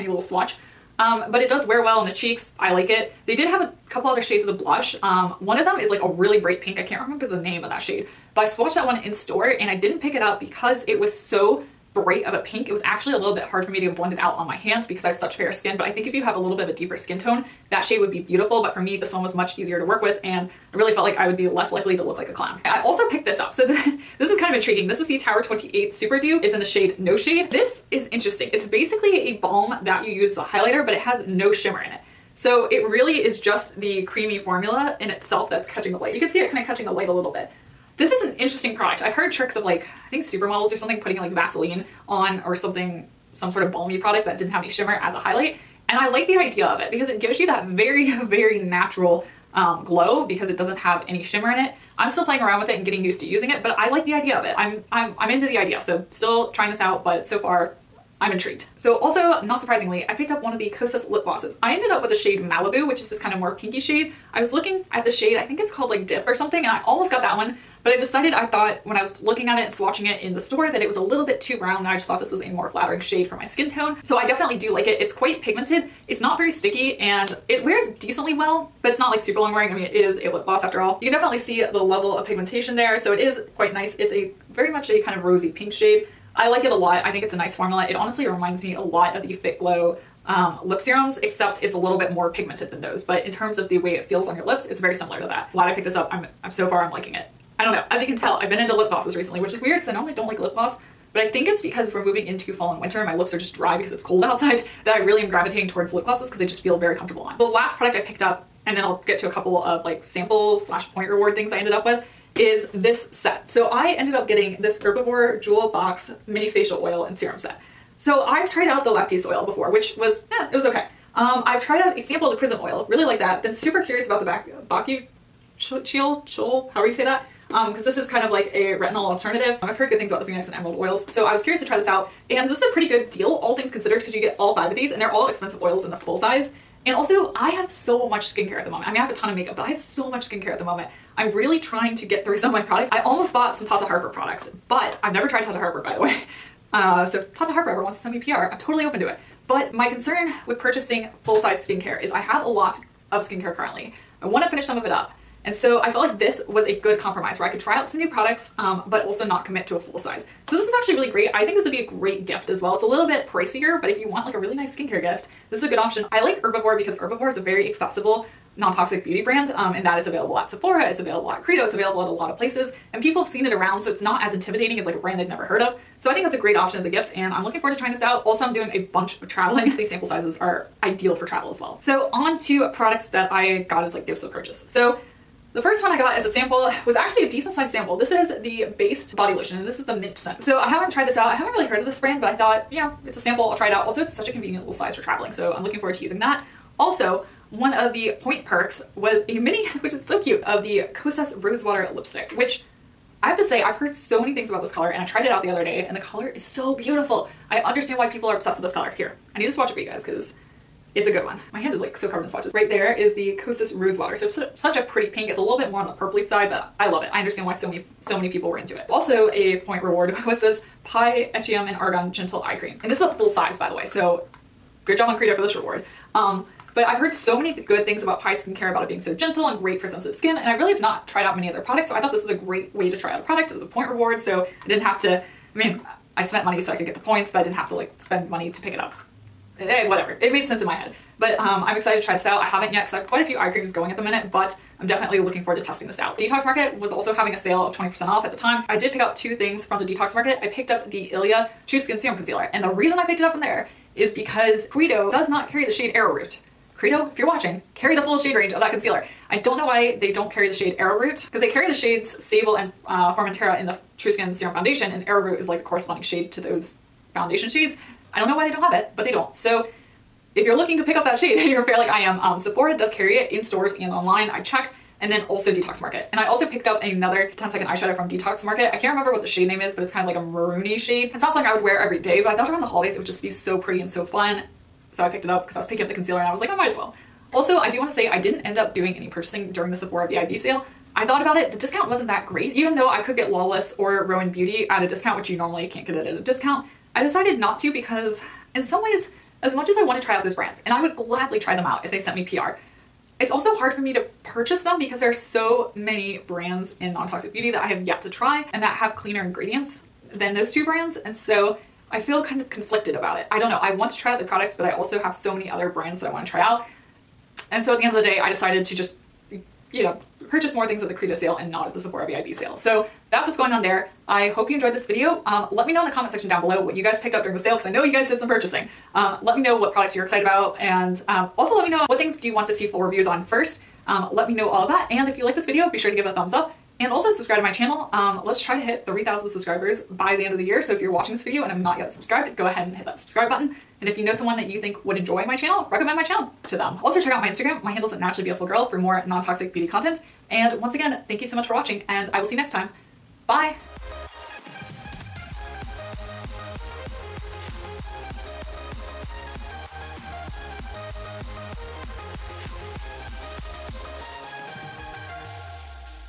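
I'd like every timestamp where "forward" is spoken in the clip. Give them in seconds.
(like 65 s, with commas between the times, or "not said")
177 s, 195 s, 245 s.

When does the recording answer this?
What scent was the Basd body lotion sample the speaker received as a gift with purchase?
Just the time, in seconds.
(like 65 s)
189 s.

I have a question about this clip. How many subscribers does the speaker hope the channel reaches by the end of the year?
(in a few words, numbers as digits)
3,000.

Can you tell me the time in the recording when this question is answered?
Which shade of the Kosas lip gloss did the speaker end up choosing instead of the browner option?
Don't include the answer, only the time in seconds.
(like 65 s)
62 s.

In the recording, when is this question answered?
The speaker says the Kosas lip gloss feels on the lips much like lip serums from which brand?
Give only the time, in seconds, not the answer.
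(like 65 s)
89 s.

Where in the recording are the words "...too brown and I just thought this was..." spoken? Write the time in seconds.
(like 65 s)
71 s.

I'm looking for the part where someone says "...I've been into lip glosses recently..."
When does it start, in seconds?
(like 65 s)
98 s.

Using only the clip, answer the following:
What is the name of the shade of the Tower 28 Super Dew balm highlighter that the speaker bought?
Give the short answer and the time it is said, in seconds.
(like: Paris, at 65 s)
No Shade, at 26 s.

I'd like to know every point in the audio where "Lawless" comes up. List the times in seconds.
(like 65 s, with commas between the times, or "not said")
293 s.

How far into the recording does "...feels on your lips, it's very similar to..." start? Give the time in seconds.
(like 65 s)
94 s.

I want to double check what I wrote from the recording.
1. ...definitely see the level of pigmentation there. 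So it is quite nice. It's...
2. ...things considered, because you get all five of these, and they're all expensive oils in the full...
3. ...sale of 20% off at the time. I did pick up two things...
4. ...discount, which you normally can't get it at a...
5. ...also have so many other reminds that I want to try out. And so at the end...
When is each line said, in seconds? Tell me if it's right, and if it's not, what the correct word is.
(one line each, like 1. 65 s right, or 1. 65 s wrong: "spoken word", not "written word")
1. 81 s right
2. 133 s right
3. 247 s right
4. 294 s right
5. 314 s wrong: "brands", not "reminds".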